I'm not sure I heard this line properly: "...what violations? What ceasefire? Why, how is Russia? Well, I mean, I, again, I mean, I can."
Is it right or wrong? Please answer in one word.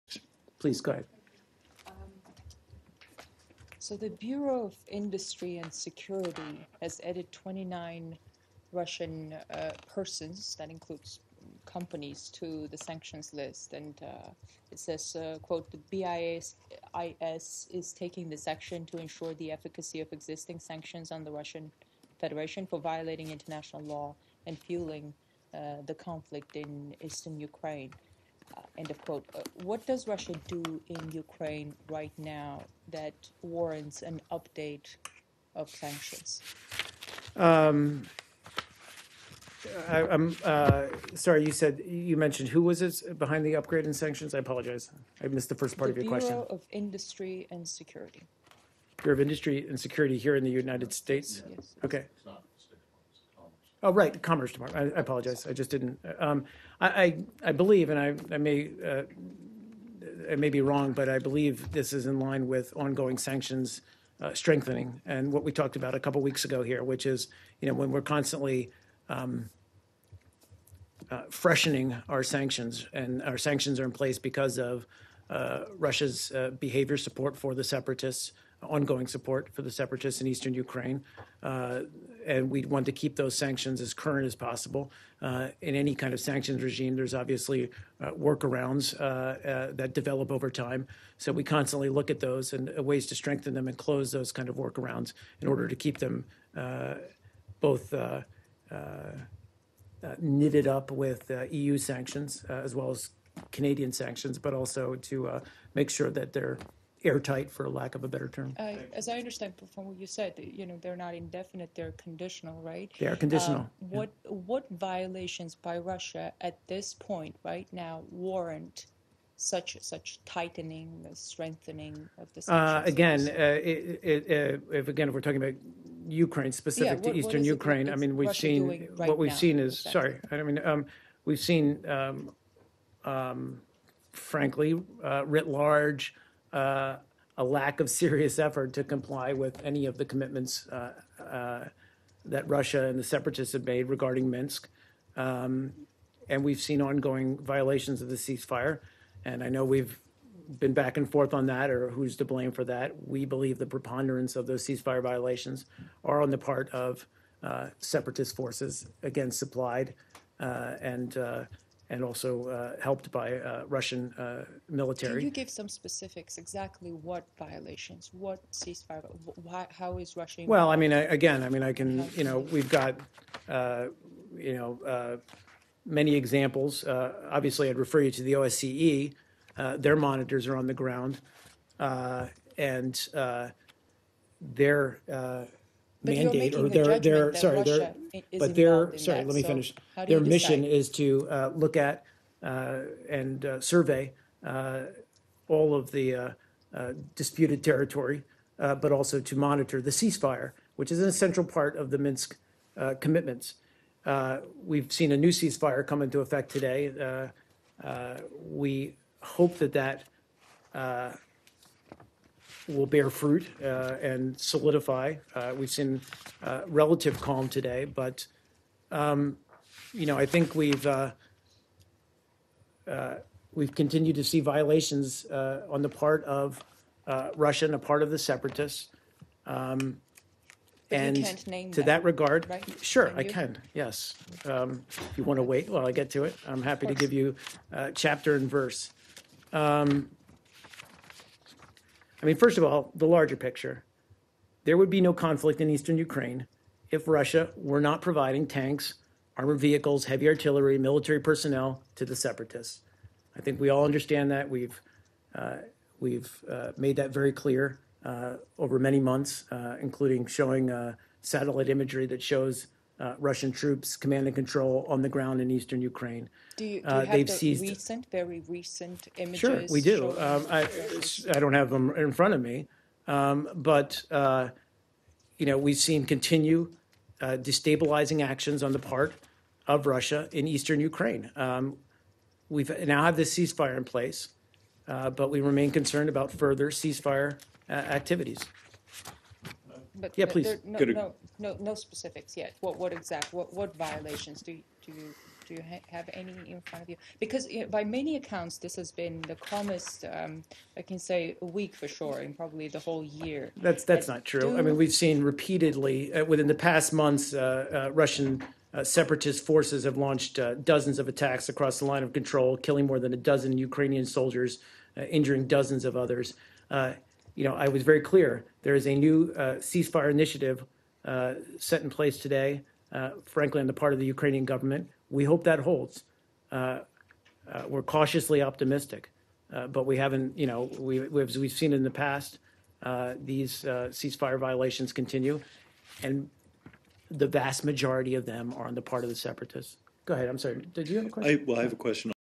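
right.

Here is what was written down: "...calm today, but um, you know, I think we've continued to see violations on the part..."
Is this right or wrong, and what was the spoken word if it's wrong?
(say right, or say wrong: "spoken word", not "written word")
right.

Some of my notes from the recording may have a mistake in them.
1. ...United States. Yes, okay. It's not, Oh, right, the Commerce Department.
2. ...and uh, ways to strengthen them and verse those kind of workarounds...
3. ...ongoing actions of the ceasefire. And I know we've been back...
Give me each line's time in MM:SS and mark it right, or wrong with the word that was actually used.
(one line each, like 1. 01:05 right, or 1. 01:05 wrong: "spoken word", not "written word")
1. 00:50 right
2. 01:32 wrong: "close", not "verse"
3. 02:26 wrong: "violations", not "actions".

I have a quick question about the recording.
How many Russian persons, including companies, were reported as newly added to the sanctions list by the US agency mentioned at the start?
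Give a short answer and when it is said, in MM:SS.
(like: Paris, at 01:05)
29, at 00:07.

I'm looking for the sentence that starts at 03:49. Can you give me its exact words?
Um, and- You can't name them.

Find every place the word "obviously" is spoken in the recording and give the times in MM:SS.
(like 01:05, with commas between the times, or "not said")
01:27, 02:57.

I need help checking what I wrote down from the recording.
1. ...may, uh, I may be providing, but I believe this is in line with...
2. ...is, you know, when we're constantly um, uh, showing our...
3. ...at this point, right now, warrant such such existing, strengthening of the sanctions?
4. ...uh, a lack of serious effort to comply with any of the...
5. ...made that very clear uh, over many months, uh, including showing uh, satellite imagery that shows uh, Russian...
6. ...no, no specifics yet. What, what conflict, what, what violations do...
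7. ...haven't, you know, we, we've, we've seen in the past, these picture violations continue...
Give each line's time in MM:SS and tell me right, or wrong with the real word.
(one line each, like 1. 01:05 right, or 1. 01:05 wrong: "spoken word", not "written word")
1. 00:58 wrong: "wrong", not "providing"
2. 01:07 wrong: "freshening", not "showing"
3. 01:56 wrong: "tightening", not "existing"
4. 02:16 right
5. 04:16 right
6. 04:51 wrong: "exact", not "conflict"
7. 05:29 wrong: "ceasefire", not "picture".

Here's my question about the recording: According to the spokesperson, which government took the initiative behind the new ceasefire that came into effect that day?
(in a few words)
Ukrainian government.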